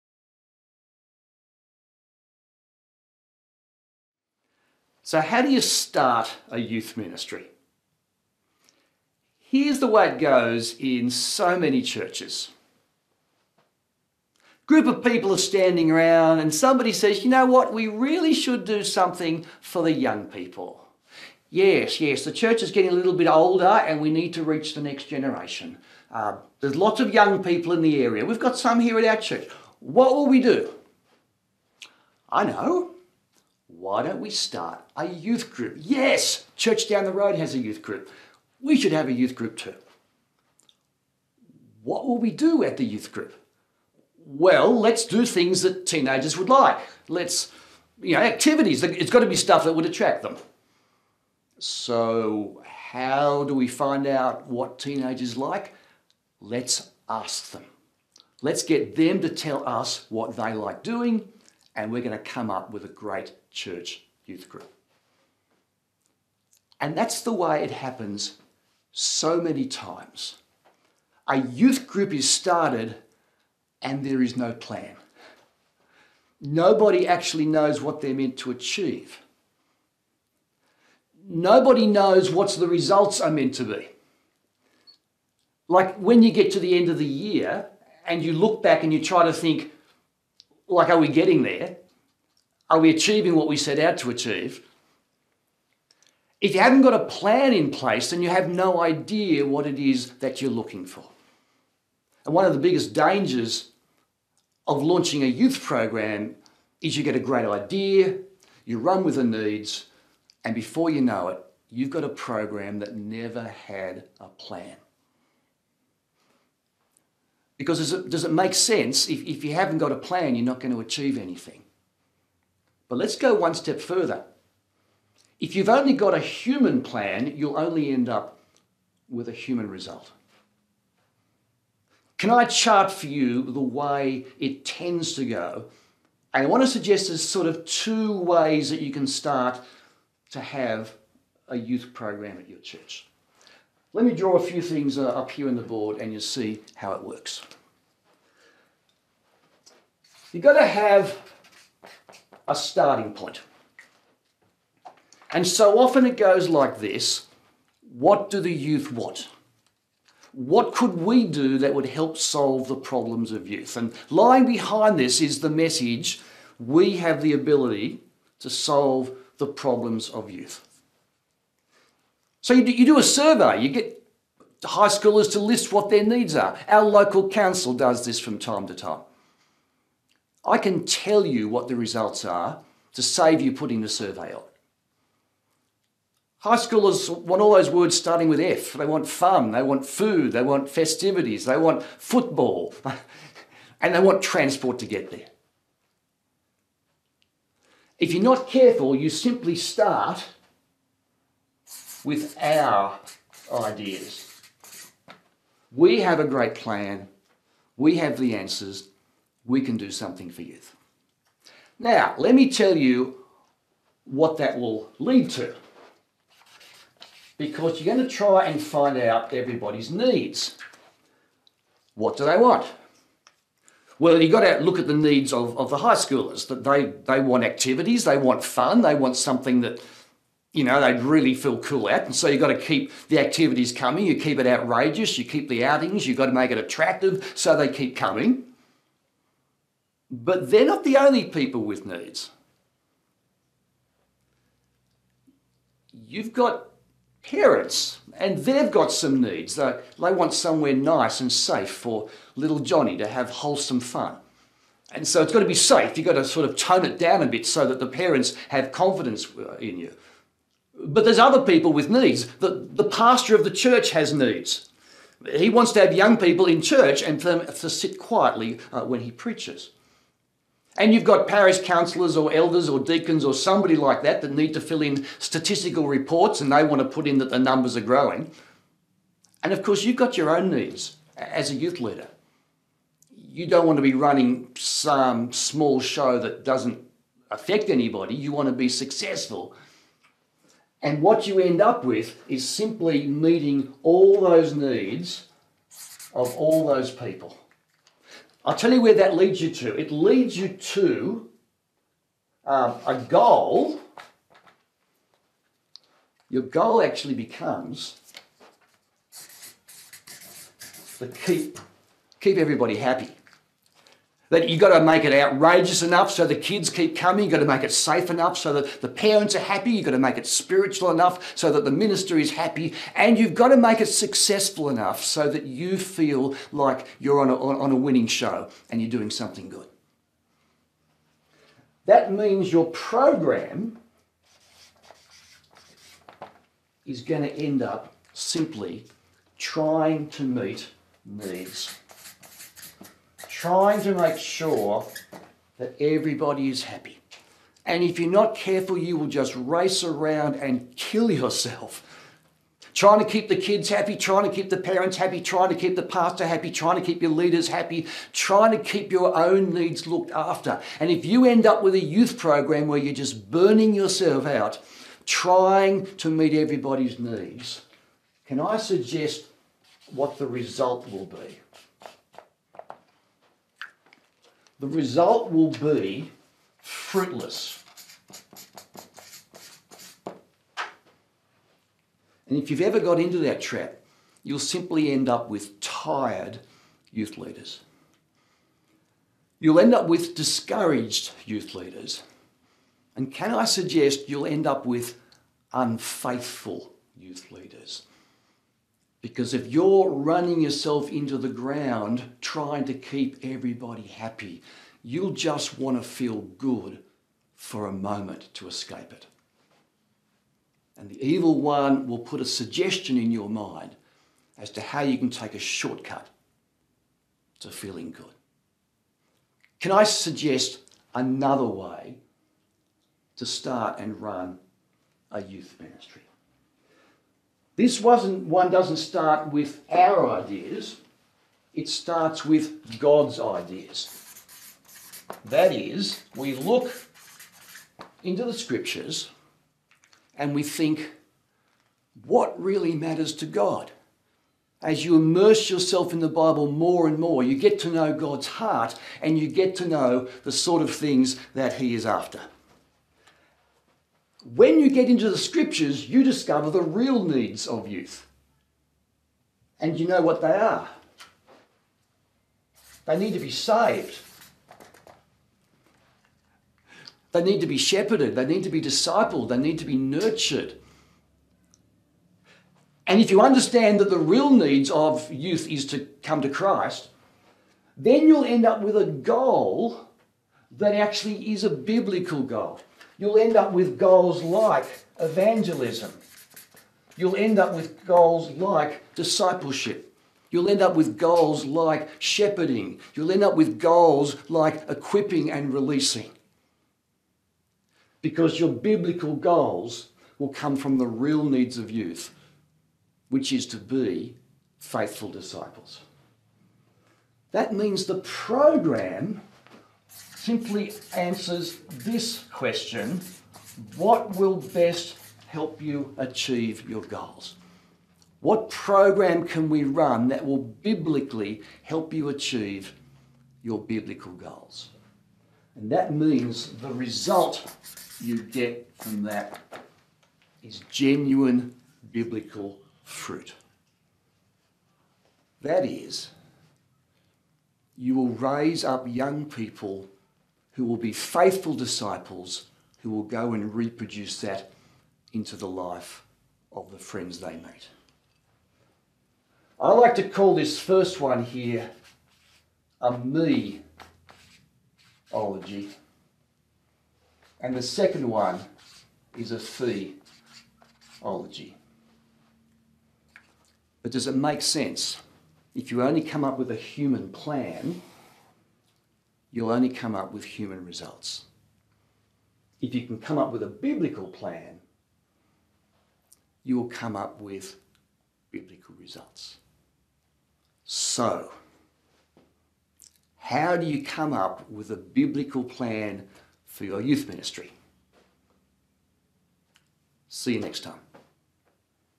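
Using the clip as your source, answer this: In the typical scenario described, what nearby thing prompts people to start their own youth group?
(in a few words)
church down the road.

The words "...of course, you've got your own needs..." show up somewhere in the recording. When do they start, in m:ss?
4:39.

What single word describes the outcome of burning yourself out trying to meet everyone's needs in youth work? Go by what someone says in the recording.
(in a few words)
fruitless.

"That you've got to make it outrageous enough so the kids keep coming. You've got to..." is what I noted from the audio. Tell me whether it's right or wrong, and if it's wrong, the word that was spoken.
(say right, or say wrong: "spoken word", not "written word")
right.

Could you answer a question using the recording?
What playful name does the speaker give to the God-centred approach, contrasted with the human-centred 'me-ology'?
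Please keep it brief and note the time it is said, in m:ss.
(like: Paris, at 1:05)
fee ology, at 9:19.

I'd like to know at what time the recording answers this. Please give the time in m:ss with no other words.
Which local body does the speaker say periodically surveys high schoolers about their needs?
2:56.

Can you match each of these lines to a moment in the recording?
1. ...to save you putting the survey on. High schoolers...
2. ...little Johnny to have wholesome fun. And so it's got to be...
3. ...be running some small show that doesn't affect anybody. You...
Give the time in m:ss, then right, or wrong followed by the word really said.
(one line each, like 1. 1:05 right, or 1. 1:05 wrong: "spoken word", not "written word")
1. 3:02 right
2. 4:12 right
3. 4:43 right.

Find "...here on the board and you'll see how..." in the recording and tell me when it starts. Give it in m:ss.
2:25.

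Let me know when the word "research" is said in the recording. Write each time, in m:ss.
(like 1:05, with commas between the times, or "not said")
not said.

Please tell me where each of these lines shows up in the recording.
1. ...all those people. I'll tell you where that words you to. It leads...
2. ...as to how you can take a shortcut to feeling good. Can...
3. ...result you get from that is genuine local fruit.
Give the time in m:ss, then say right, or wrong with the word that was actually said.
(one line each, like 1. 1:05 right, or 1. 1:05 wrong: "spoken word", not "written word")
1. 4:56 wrong: "leads", not "words"
2. 6:54 right
3. 8:46 wrong: "biblical", not "local".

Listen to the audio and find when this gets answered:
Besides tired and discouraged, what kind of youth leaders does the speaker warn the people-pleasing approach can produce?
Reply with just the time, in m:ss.
6:35.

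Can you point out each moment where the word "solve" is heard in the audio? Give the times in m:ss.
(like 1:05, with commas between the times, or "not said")
2:42, 2:48.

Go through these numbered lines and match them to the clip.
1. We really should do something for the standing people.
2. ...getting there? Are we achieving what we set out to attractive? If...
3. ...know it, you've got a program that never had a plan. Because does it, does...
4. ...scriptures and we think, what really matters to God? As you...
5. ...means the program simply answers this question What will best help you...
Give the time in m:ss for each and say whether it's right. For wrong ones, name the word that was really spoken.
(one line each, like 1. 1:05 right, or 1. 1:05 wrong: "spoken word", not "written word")
1. 0:17 wrong: "young", not "standing"
2. 1:31 wrong: "achieve", not "attractive"
3. 1:51 right
4. 7:18 right
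5. 8:27 right.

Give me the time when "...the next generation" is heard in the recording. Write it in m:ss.
0:24.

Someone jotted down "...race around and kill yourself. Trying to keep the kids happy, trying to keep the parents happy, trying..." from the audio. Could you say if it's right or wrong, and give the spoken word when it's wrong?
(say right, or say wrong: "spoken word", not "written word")
right.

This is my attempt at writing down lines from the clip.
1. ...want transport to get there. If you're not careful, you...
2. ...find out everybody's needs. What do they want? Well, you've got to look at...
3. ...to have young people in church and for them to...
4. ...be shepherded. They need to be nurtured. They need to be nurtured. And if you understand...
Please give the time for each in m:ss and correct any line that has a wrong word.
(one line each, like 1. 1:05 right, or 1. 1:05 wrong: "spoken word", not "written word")
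1. 3:13 right
2. 3:38 right
3. 4:25 right
4. 7:47 wrong: "discipled", not "nurtured".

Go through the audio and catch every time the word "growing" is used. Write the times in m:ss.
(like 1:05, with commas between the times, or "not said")
4:37.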